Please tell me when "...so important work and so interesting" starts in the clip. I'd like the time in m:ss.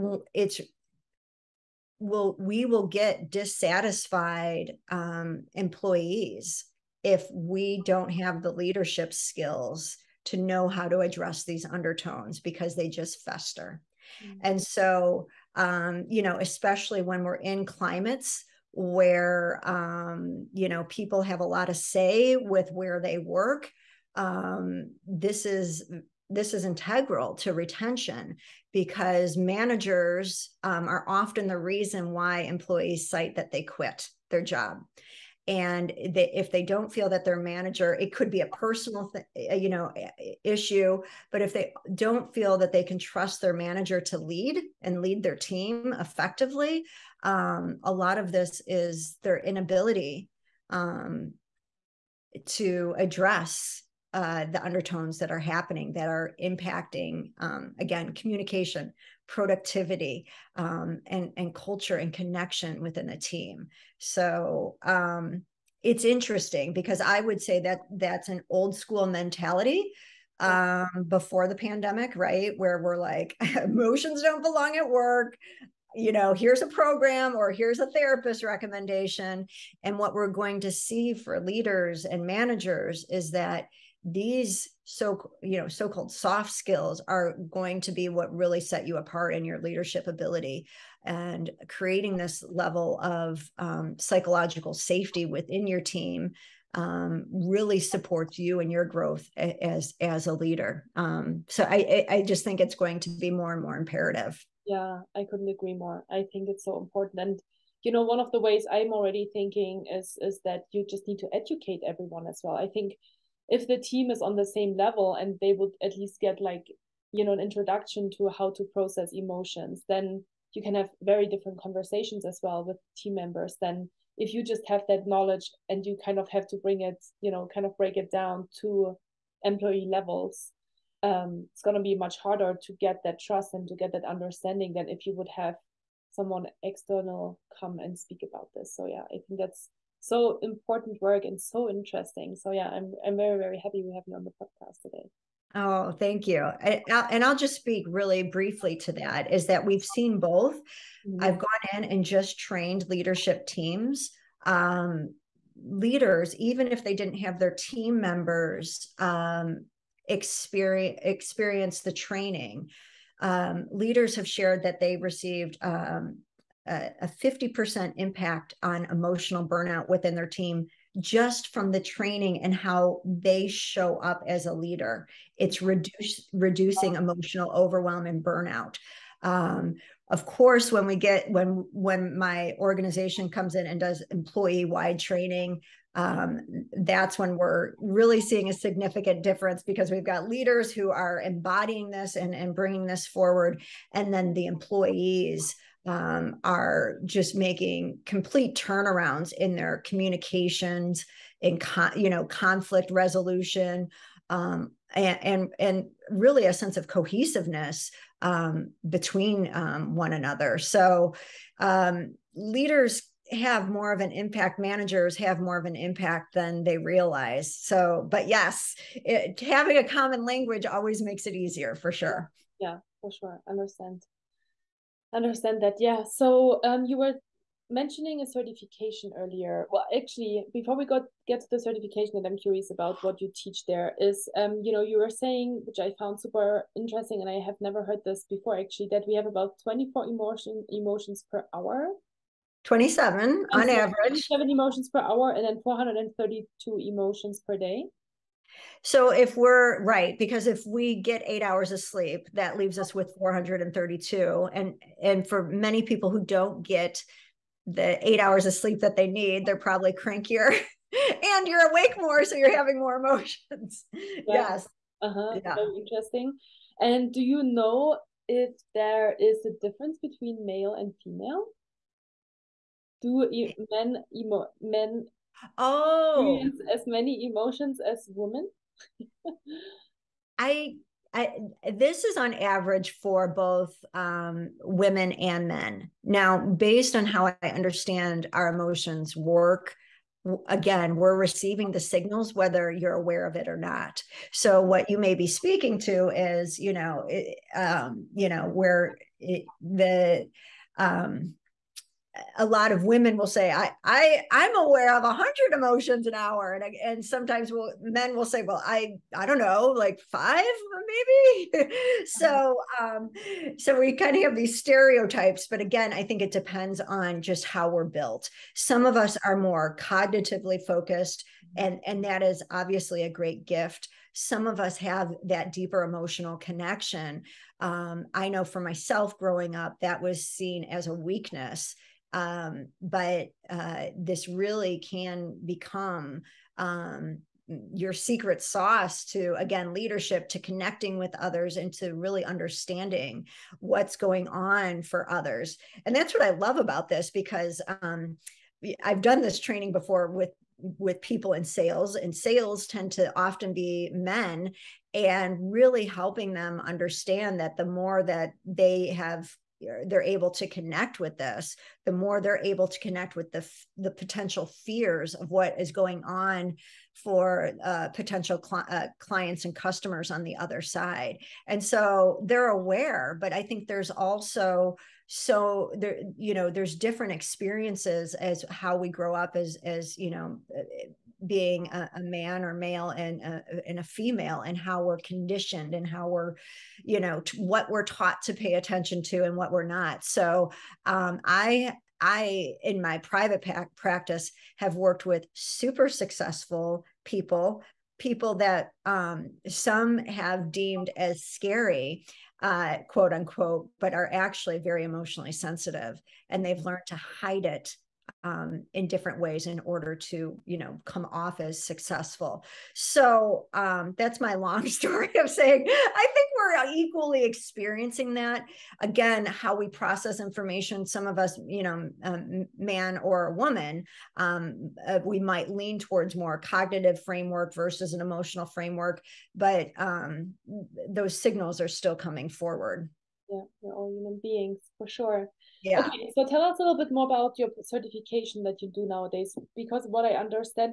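2:20.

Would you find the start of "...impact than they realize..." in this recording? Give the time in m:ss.
3:35.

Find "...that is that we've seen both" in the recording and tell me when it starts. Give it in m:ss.
2:28.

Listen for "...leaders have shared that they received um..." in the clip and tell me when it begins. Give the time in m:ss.
2:43.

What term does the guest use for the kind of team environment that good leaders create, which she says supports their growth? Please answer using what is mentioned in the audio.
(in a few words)
psychological safety.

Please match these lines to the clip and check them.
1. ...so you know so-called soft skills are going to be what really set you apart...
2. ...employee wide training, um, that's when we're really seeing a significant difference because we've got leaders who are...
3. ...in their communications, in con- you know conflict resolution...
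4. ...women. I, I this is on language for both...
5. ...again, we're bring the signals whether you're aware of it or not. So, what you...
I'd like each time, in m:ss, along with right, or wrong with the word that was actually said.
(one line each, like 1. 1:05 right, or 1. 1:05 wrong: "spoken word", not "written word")
1. 1:24 right
2. 3:04 right
3. 3:19 right
4. 4:38 wrong: "average", not "language"
5. 4:50 wrong: "receiving", not "bring".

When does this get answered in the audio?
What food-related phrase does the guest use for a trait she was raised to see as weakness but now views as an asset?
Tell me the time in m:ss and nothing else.
5:37.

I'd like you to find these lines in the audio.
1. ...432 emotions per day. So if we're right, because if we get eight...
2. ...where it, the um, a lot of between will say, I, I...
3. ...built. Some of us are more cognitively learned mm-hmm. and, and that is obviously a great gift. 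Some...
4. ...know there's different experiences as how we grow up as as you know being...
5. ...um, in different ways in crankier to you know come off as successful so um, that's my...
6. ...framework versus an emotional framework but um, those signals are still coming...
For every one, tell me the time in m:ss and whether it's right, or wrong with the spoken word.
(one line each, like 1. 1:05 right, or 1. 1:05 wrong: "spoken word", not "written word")
1. 4:05 right
2. 4:58 wrong: "women", not "between"
3. 5:17 wrong: "focused", not "learned"
4. 6:16 right
5. 6:48 wrong: "order", not "crankier"
6. 7:07 right.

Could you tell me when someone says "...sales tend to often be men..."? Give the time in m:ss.
5:52.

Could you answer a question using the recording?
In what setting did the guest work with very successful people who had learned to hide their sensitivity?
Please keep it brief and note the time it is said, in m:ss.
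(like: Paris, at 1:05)
private practice, at 6:32.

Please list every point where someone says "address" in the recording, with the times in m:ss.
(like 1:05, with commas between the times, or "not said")
0:10, 0:52.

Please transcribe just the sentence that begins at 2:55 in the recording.
It's reduce, reducing emotional overwhelm and burnout.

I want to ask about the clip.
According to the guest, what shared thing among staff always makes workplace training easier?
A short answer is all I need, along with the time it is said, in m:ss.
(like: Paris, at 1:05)
a common language, at 3:39.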